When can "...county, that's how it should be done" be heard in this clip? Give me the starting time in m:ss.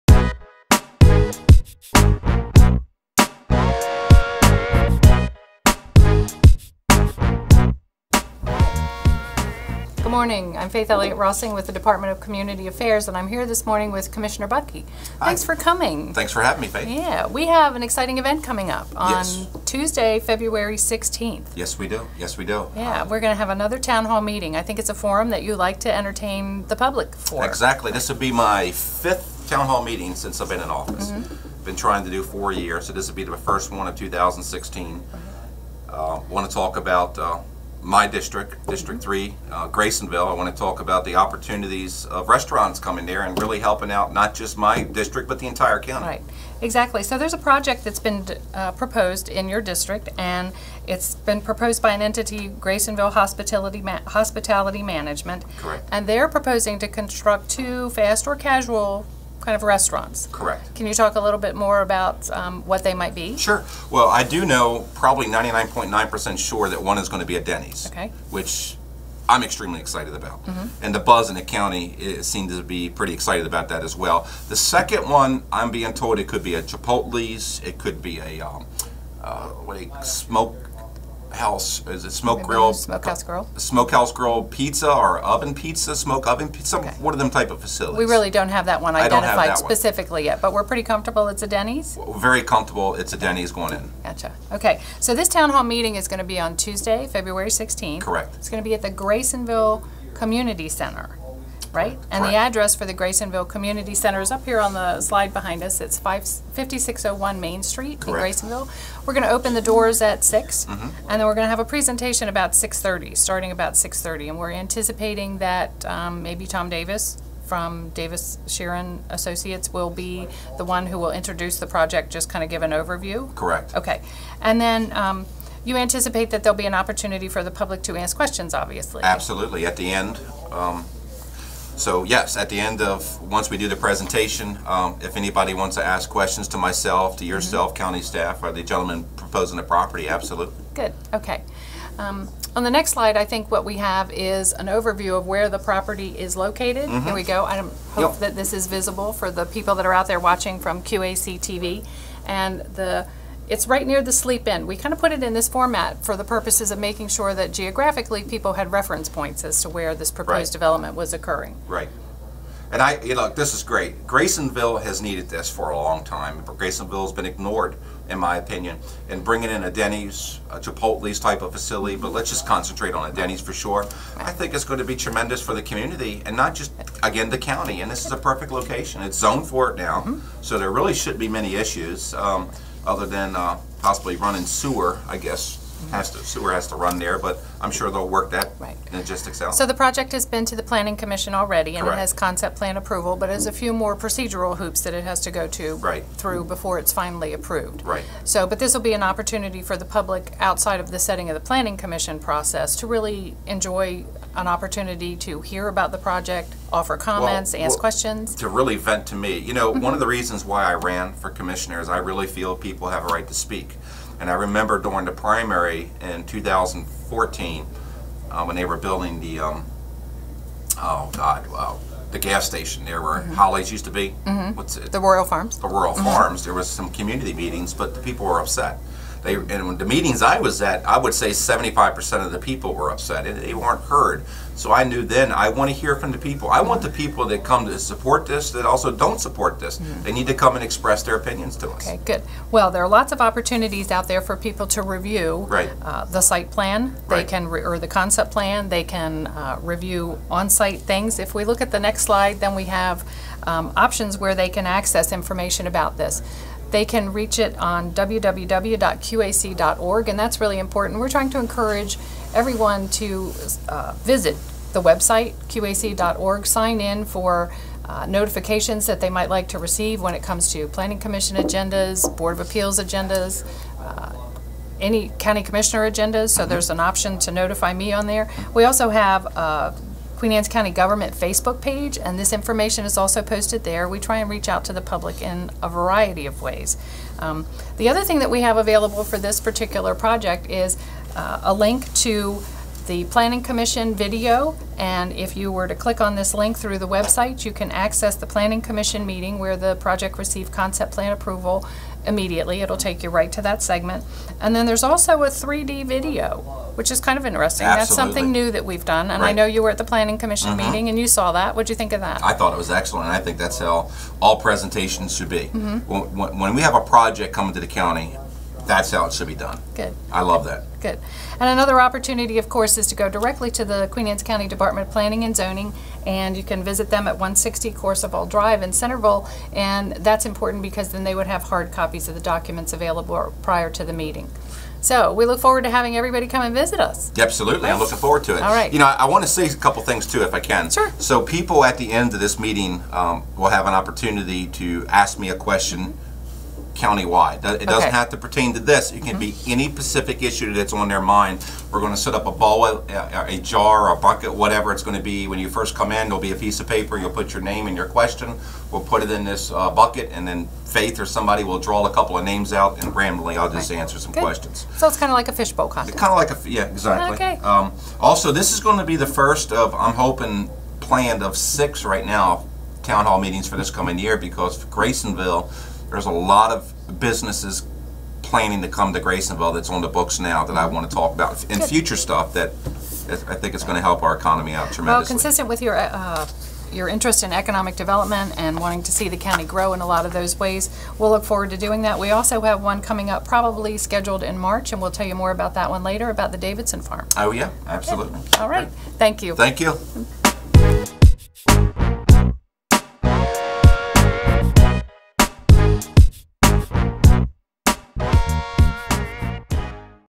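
5:17.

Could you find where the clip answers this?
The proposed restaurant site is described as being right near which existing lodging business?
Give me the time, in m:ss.
2:34.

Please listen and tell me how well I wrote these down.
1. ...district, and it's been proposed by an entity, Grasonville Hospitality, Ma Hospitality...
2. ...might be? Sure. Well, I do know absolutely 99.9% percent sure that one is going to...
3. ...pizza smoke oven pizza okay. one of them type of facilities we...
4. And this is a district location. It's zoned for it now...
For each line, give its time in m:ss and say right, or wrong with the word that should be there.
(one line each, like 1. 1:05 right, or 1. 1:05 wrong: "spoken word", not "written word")
1. 0:49 right
2. 1:02 wrong: "probably", not "absolutely"
3. 1:25 right
4. 2:57 wrong: "perfect", not "district".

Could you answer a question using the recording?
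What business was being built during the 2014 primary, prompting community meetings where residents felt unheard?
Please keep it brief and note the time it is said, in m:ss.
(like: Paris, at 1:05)
Royal Farms, at 3:44.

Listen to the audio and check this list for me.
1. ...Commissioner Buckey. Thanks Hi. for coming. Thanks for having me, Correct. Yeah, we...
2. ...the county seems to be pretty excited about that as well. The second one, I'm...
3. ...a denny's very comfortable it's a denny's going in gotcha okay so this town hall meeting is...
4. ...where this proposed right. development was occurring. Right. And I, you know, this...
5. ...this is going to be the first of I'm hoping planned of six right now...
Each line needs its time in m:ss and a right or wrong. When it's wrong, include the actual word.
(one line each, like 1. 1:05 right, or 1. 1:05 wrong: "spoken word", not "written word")
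1. 0:14 wrong: "Faith", not "Correct"
2. 1:11 right
3. 1:31 right
4. 2:39 right
5. 6:08 right.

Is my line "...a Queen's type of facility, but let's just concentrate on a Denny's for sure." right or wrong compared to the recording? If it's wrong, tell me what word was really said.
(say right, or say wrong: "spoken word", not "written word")
wrong: "Chipotle", not "Queen".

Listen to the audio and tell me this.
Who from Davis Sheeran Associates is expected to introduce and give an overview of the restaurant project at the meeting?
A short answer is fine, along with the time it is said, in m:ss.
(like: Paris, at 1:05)
Tom Davis, at 1:56.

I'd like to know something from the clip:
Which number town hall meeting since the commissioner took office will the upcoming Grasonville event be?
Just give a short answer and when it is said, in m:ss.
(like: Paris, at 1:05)
5th, at 0:28.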